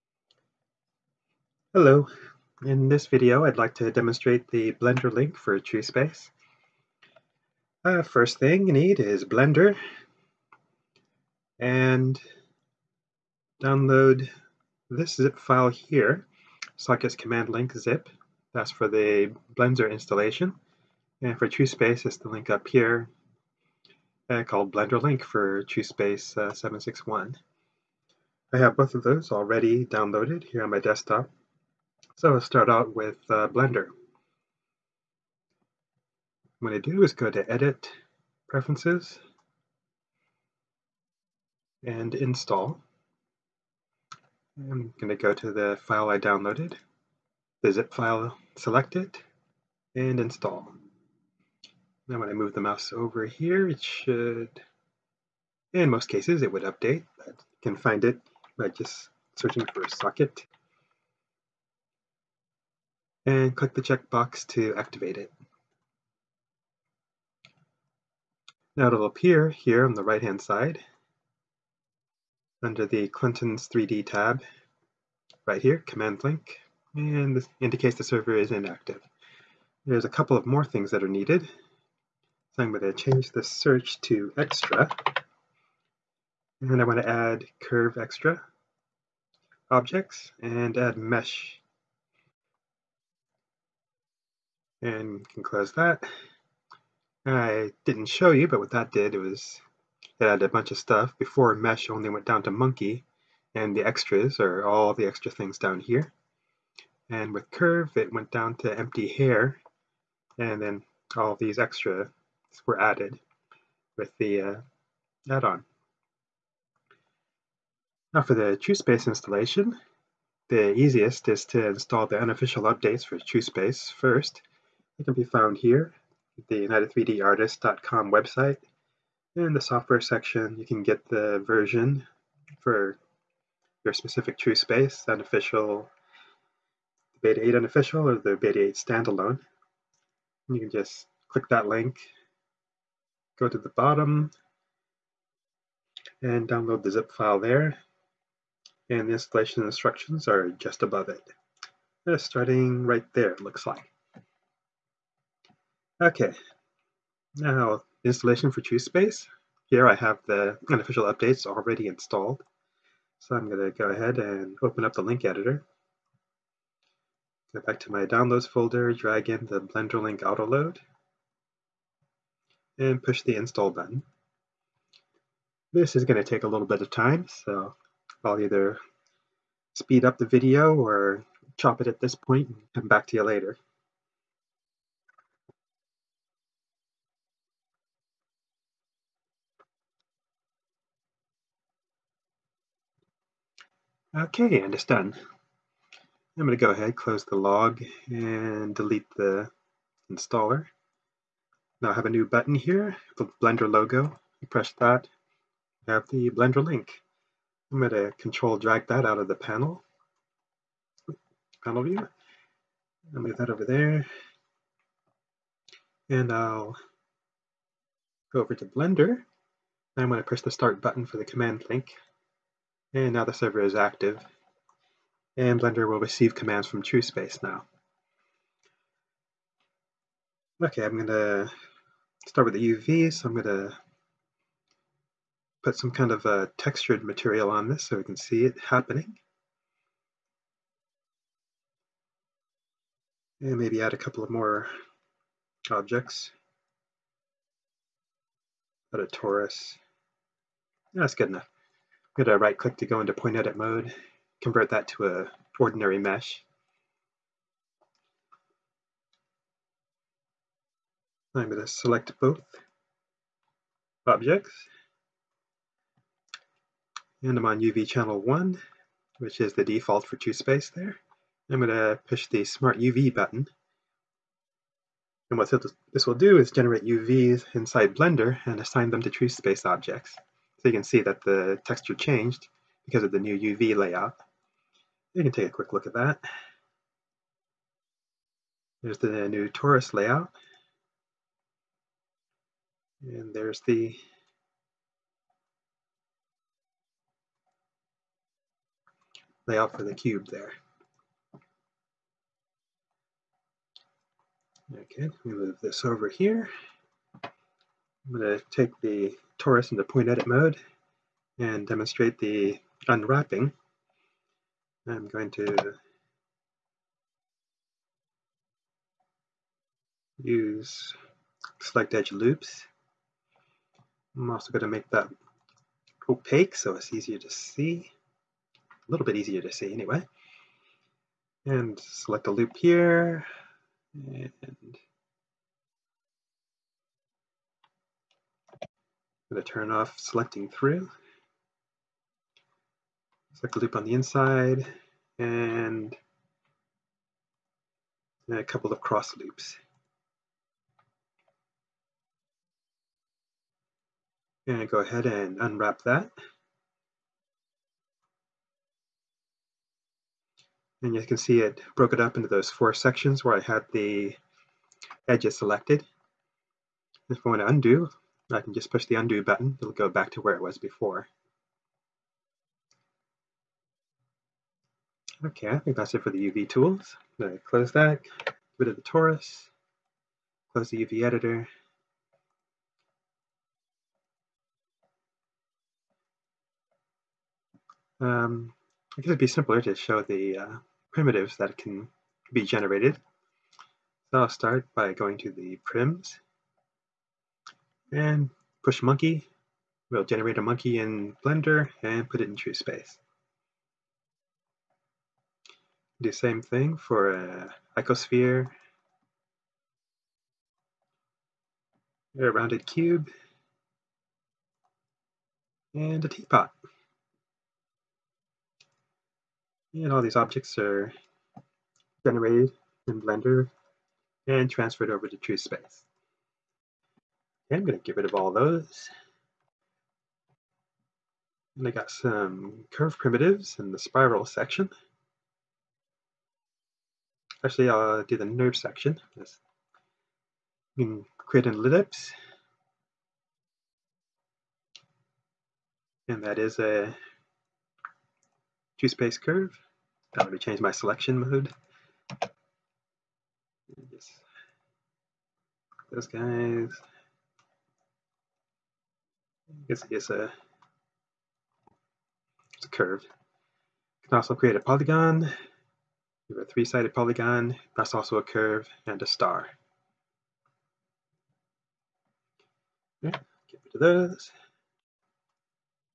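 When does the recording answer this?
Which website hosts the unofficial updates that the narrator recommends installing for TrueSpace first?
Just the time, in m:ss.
2:06.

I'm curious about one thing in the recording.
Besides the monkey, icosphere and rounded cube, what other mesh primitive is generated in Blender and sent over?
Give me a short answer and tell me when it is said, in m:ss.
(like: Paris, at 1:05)
teapot, at 6:56.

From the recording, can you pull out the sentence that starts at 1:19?
There's a couple of more things that are needed.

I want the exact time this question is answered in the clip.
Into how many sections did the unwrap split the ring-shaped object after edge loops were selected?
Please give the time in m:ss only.
6:02.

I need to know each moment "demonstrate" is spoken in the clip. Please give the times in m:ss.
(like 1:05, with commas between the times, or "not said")
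0:03, 5:11.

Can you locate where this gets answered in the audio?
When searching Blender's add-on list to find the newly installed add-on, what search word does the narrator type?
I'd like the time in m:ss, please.
0:59.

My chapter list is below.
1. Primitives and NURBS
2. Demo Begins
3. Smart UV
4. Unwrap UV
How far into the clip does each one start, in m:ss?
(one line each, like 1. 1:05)
1. 6:34
2. 3:42
3. 4:29
4. 5:09.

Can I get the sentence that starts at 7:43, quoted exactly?
You can also create a polygon.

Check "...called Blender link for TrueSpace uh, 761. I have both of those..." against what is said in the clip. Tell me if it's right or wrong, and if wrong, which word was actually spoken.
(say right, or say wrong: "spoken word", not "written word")
right.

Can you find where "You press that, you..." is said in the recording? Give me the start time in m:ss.
3:24.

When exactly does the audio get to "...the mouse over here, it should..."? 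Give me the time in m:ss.
0:52.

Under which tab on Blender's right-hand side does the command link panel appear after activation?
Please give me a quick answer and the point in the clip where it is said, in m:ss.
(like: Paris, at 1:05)
Clinton's 3D, at 1:13.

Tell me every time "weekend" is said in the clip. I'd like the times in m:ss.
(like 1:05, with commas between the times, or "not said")
not said.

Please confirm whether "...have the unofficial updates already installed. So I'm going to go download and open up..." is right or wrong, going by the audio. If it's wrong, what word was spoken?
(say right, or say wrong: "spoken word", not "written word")
wrong: "ahead", not "download".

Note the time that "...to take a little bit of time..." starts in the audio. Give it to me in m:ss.
2:56.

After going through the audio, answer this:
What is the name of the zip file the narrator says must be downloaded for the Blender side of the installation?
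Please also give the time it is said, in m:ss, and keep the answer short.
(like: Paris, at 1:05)
sockets command link zip, at 0:16.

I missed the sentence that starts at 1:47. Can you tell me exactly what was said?
And with curve, it went down to empty hair, and then all these extra were added with the uh, add-on.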